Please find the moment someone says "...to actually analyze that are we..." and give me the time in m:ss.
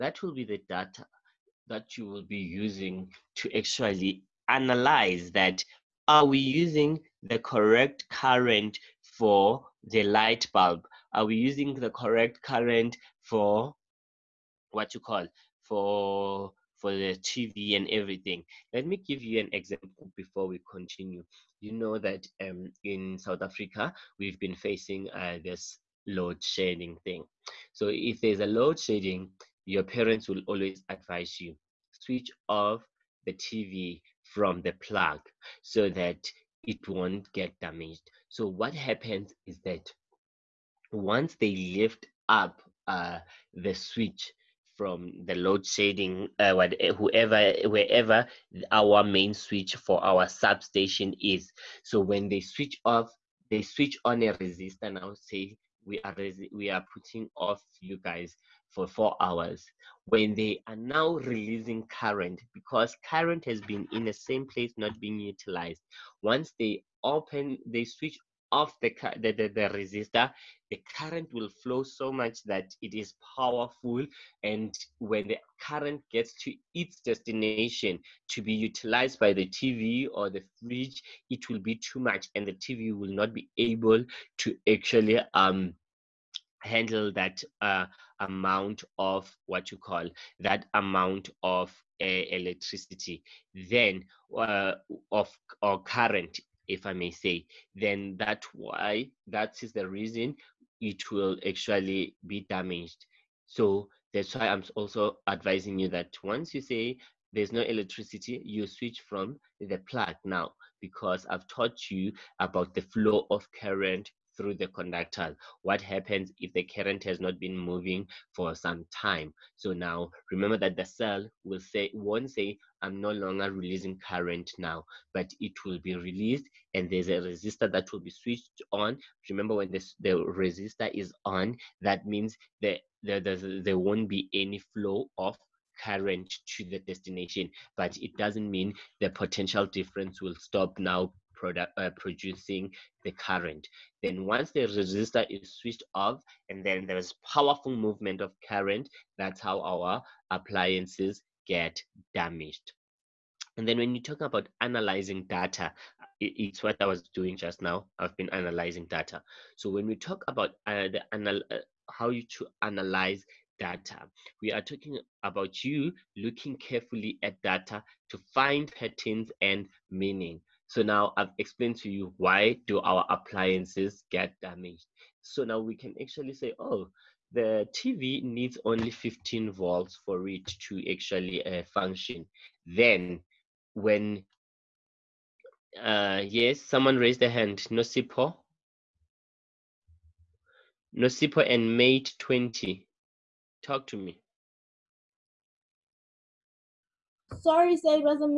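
0:03.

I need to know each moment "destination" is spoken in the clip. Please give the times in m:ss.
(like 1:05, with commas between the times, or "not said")
1:16, 2:16.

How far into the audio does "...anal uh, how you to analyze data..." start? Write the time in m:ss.
2:41.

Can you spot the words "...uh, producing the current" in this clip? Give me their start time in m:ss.
2:21.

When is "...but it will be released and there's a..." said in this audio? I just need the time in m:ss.
2:05.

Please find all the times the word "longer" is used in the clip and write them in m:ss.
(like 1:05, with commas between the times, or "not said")
2:03.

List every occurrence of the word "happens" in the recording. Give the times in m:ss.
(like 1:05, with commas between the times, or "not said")
0:38, 1:55.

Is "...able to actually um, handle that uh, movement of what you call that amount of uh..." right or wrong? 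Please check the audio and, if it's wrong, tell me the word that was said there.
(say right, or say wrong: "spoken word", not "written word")
wrong: "amount", not "movement".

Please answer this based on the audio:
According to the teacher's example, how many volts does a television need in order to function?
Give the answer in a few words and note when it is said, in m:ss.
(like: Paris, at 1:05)
15, at 2:58.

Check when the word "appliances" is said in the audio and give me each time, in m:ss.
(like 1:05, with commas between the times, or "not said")
2:30, 2:53.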